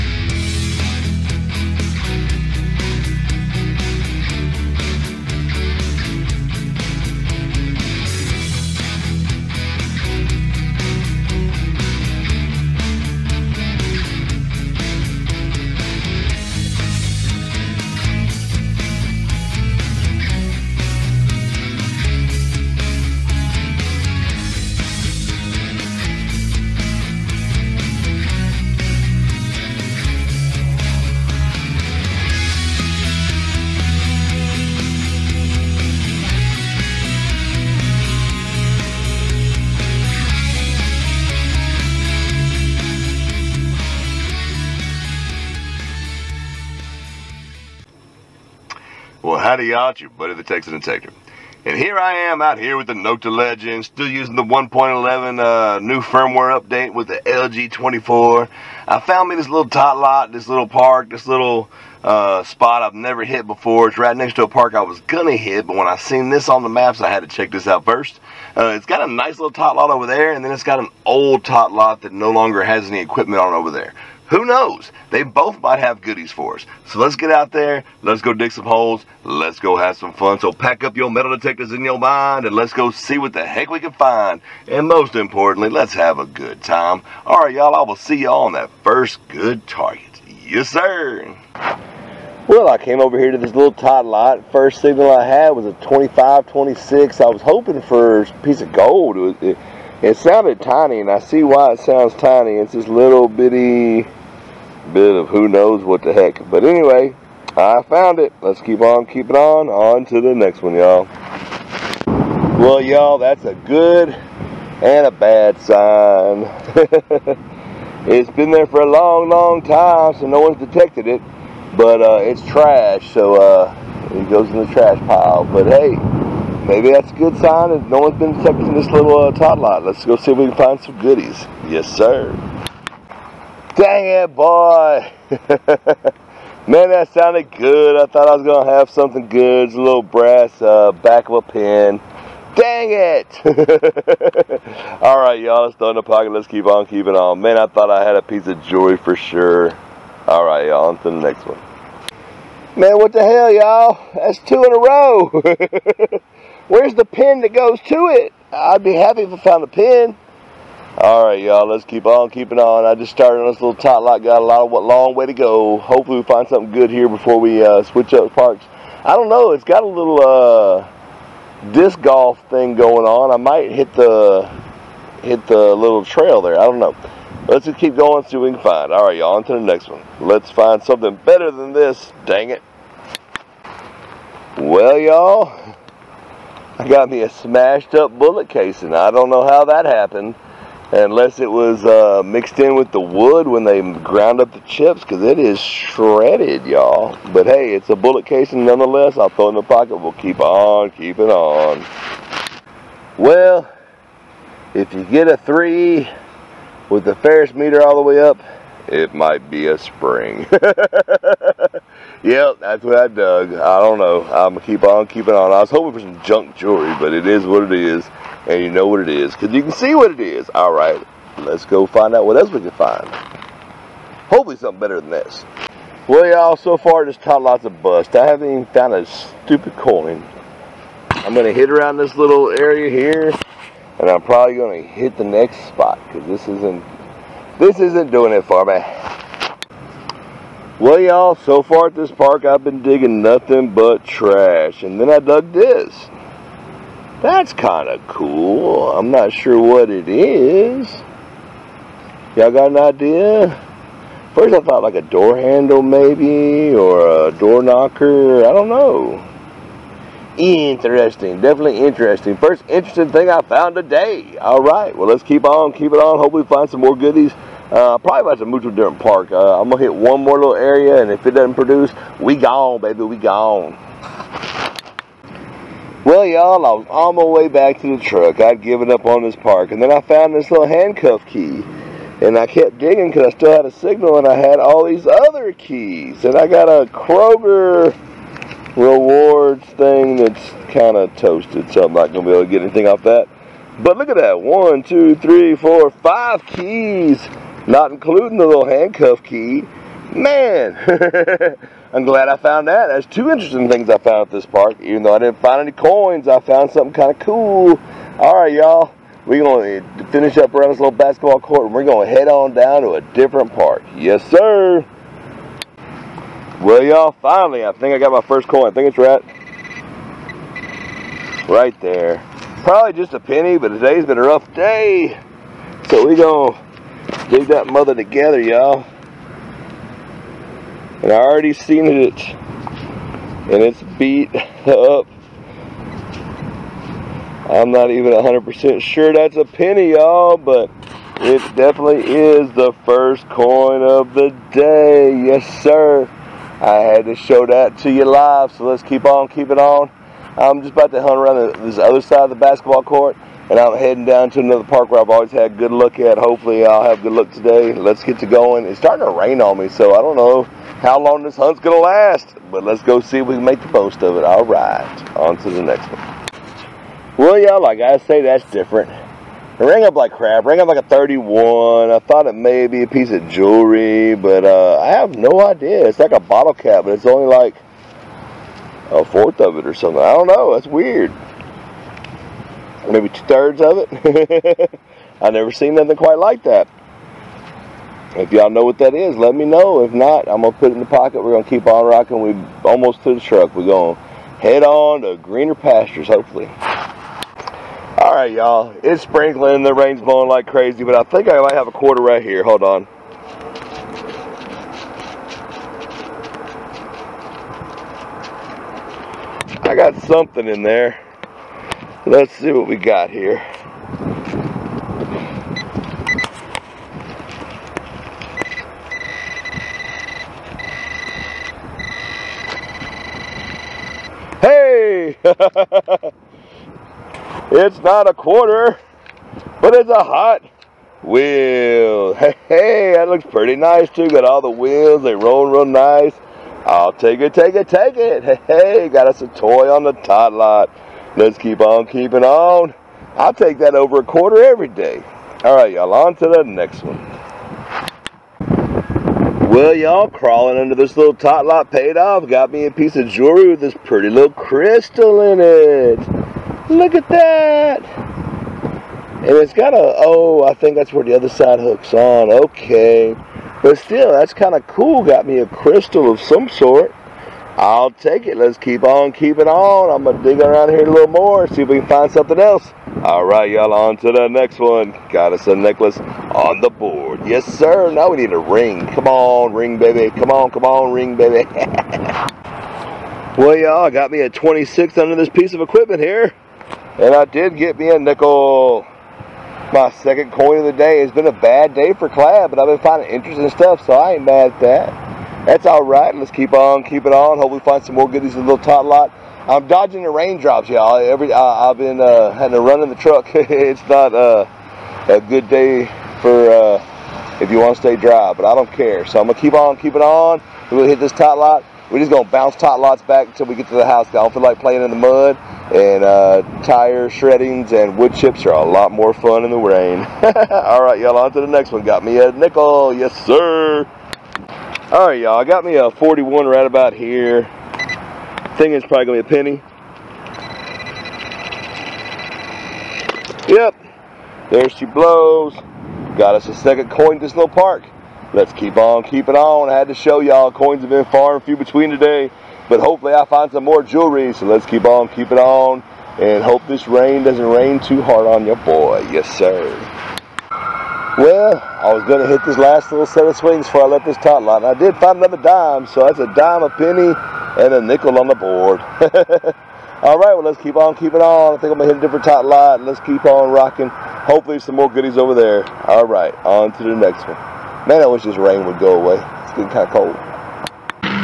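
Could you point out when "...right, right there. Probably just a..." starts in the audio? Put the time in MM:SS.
05:18.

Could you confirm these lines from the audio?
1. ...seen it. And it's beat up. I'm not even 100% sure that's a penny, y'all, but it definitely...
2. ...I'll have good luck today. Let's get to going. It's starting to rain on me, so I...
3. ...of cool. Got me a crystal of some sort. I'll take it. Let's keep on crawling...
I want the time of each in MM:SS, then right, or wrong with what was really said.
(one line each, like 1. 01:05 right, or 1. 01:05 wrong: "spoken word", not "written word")
1. 05:31 right
2. 05:56 right
3. 07:44 wrong: "keeping", not "crawling".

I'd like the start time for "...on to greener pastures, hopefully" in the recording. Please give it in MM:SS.
06:34.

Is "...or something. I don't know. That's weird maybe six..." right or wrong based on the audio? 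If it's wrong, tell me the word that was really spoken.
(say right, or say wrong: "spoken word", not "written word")
wrong: "two", not "six".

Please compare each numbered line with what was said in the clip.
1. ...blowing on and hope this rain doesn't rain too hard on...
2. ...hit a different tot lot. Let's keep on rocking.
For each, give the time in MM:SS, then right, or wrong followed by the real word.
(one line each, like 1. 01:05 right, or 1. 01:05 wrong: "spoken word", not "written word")
1. 09:05 wrong: "keeping", not "blowing"
2. 09:21 right.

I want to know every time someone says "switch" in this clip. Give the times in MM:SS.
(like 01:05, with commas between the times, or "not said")
02:47.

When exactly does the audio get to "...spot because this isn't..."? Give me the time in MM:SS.
03:55.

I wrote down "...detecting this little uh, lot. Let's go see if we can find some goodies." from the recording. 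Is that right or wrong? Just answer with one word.
right.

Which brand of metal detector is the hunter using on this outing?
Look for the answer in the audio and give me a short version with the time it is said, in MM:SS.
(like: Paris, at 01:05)
Nokta Legend, at 00:52.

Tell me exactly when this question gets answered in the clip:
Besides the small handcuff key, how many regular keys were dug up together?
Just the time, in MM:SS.
04:55.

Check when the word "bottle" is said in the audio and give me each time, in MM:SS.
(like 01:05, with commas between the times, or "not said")
06:16.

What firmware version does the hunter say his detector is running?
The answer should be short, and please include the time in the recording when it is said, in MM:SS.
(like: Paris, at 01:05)
1.11, at 00:54.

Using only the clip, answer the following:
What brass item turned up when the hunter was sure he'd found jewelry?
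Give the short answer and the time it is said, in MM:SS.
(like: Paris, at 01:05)
back of a pen, at 02:20.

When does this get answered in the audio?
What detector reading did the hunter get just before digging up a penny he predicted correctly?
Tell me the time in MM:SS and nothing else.
08:45.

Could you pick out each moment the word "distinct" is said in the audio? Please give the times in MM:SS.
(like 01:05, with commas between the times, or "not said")
not said.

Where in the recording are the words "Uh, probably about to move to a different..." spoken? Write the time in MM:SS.
04:27.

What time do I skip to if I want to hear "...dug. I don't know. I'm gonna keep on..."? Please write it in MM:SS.
03:33.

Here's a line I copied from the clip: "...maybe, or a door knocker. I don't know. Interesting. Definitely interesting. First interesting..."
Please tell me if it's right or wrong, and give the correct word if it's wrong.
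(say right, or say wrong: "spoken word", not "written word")
right.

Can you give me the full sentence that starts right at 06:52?
Let's see what we got here.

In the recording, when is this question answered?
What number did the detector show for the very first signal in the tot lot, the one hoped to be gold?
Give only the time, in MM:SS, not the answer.
01:35.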